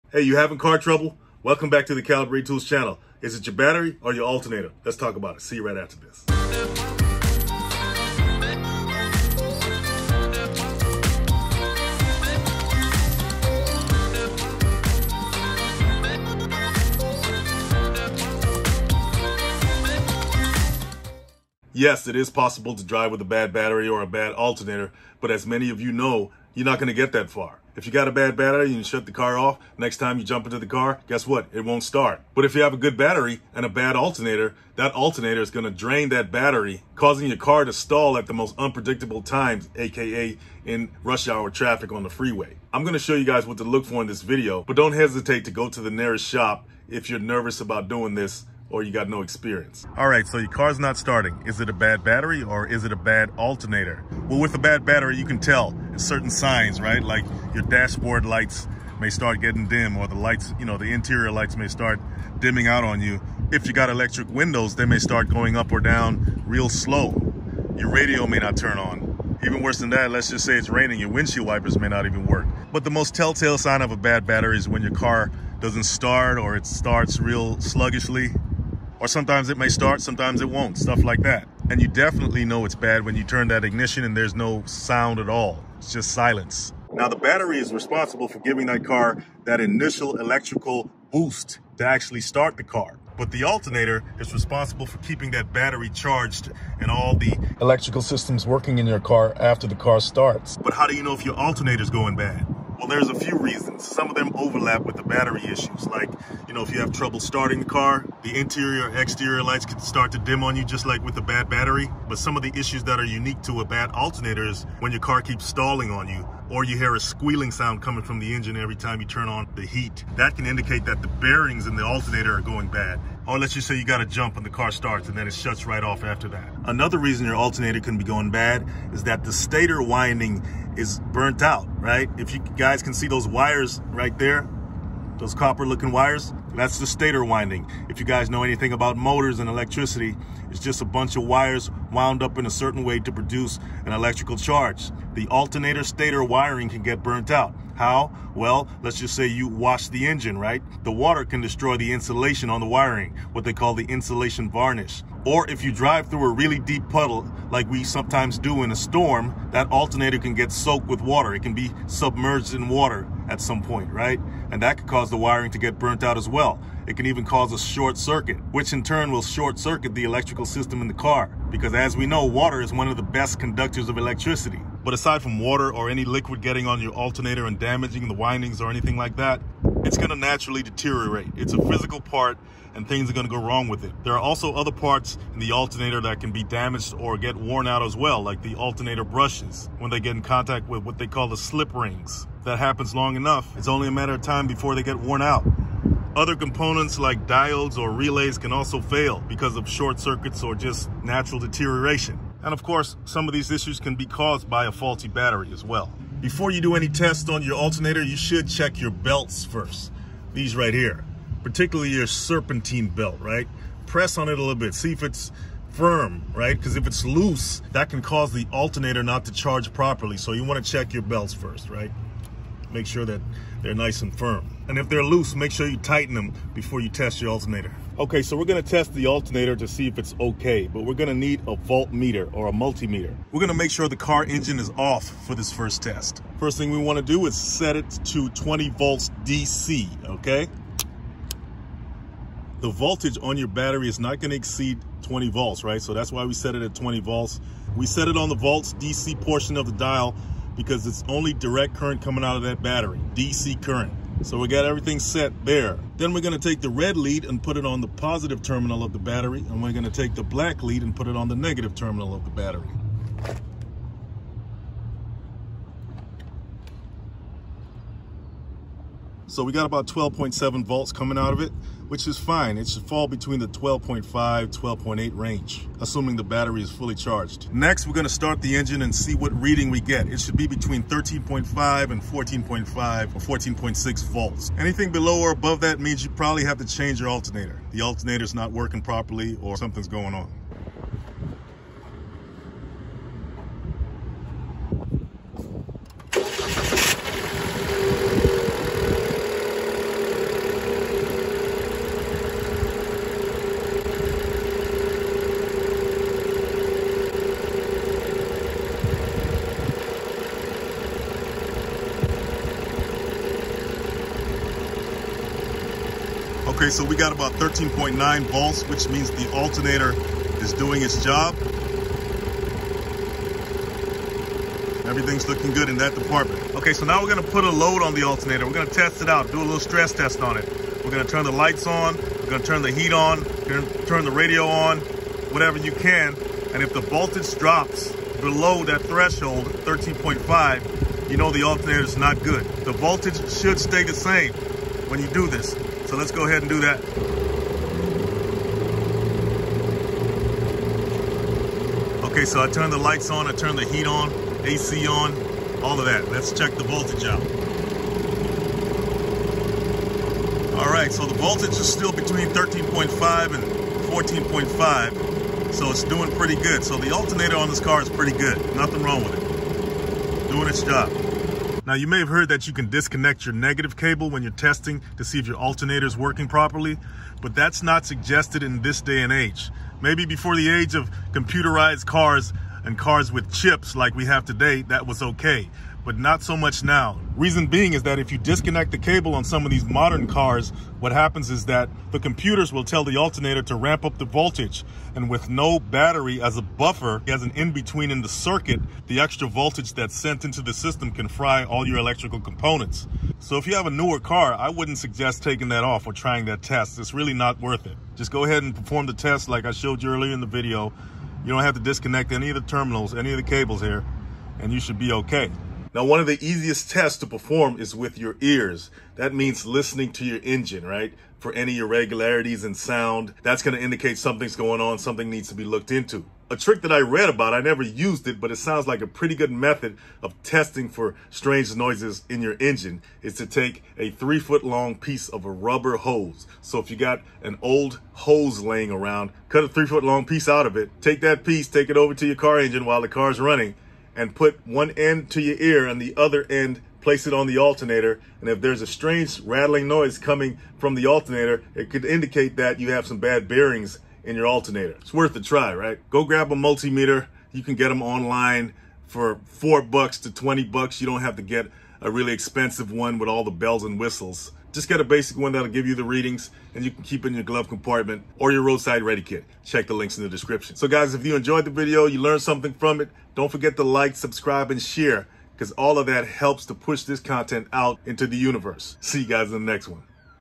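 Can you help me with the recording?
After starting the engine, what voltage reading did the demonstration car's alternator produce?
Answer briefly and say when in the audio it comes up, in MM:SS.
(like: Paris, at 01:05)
13.9 volts, at 05:17.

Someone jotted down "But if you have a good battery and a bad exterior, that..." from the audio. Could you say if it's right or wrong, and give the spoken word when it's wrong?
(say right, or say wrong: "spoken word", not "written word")
wrong: "alternator", not "exterior".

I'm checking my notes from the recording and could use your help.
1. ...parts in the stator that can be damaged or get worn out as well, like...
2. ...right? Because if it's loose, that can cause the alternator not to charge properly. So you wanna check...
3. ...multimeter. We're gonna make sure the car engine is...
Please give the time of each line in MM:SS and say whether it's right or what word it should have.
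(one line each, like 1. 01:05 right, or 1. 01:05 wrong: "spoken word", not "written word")
1. 03:04 wrong: "alternator", not "stator"
2. 03:36 right
3. 03:52 right.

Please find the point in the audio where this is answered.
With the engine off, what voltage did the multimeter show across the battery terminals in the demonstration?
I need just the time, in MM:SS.
04:29.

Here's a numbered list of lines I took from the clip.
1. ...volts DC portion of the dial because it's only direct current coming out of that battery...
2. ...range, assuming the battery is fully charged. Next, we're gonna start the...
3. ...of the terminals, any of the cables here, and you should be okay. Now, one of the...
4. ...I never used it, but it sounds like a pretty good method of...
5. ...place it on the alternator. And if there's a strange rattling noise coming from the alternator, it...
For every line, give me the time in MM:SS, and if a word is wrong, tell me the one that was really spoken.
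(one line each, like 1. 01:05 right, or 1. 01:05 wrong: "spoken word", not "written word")
1. 04:08 right
2. 04:35 right
3. 06:52 right
4. 07:07 right
5. 07:26 right.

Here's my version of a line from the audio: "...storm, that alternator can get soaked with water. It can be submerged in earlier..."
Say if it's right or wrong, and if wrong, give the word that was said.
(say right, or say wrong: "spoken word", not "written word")
wrong: "water", not "earlier".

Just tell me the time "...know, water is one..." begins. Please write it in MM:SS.
02:52.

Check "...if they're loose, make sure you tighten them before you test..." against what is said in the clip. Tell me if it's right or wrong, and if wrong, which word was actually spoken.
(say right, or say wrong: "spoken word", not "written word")
right.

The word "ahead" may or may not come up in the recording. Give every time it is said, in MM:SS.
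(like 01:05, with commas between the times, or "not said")
05:46, 06:48.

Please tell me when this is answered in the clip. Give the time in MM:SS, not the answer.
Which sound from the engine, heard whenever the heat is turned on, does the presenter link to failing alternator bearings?
01:56.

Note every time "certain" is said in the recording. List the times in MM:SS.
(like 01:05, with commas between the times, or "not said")
00:55, 02:22.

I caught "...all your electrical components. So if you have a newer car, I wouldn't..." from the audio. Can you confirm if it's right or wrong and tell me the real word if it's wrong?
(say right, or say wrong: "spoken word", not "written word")
right.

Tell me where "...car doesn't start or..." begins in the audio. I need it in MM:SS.
01:14.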